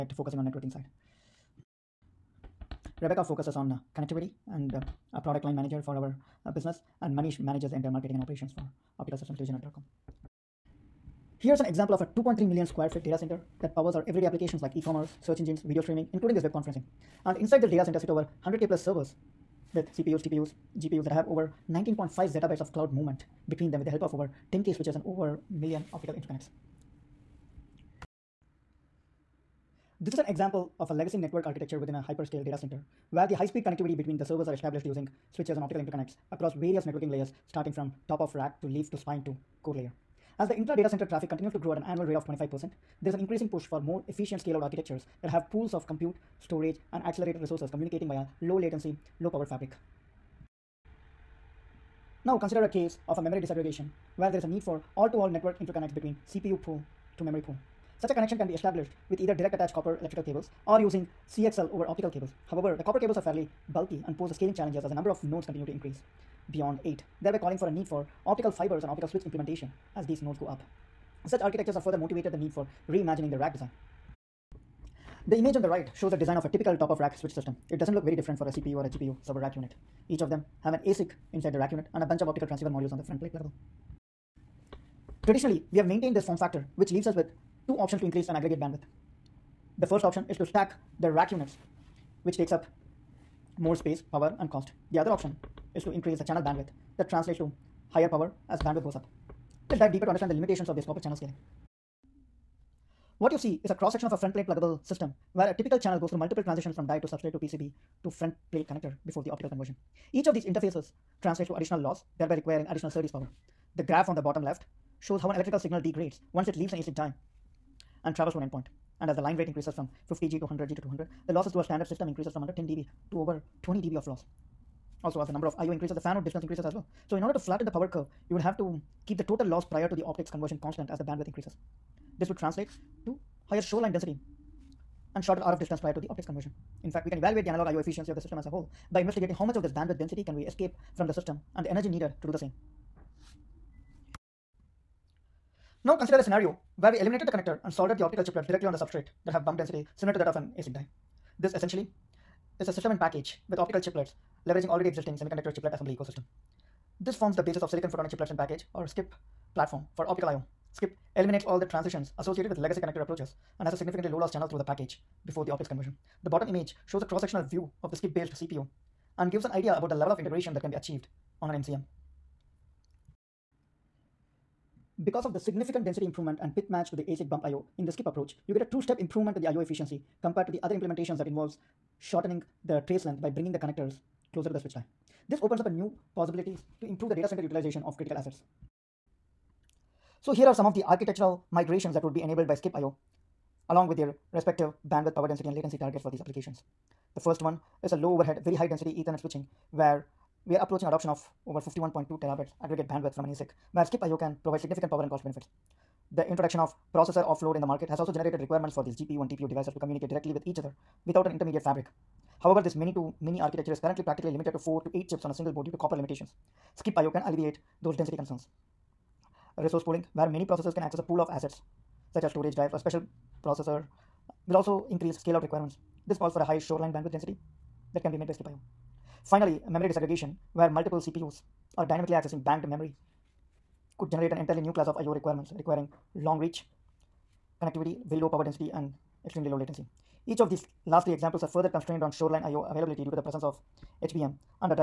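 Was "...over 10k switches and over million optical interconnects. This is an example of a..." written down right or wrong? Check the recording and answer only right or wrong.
right.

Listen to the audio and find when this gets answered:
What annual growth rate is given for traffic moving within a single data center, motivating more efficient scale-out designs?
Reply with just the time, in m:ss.
0:42.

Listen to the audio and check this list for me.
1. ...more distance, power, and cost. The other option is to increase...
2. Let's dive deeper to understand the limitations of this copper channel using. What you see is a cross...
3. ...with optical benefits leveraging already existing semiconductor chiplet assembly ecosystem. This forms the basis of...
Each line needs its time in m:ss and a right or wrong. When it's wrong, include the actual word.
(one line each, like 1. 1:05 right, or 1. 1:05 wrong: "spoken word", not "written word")
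1. 1:33 wrong: "space", not "distance"
2. 1:39 wrong: "scaling", not "using"
3. 2:33 wrong: "chiplets", not "benefits".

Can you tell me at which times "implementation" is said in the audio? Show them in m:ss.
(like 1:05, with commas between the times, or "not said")
1:09, 3:00.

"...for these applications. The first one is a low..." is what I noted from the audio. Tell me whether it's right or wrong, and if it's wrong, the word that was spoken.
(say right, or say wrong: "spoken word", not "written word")
right.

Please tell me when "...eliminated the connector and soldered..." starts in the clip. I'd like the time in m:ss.
2:26.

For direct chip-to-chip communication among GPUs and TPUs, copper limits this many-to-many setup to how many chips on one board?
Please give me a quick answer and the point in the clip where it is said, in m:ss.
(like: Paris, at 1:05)
4 to 8, at 3:34.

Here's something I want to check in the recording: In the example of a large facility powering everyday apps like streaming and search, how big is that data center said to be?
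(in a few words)
2.3 million square feet.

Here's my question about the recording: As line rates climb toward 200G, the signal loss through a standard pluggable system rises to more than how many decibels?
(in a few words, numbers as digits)
20 dB.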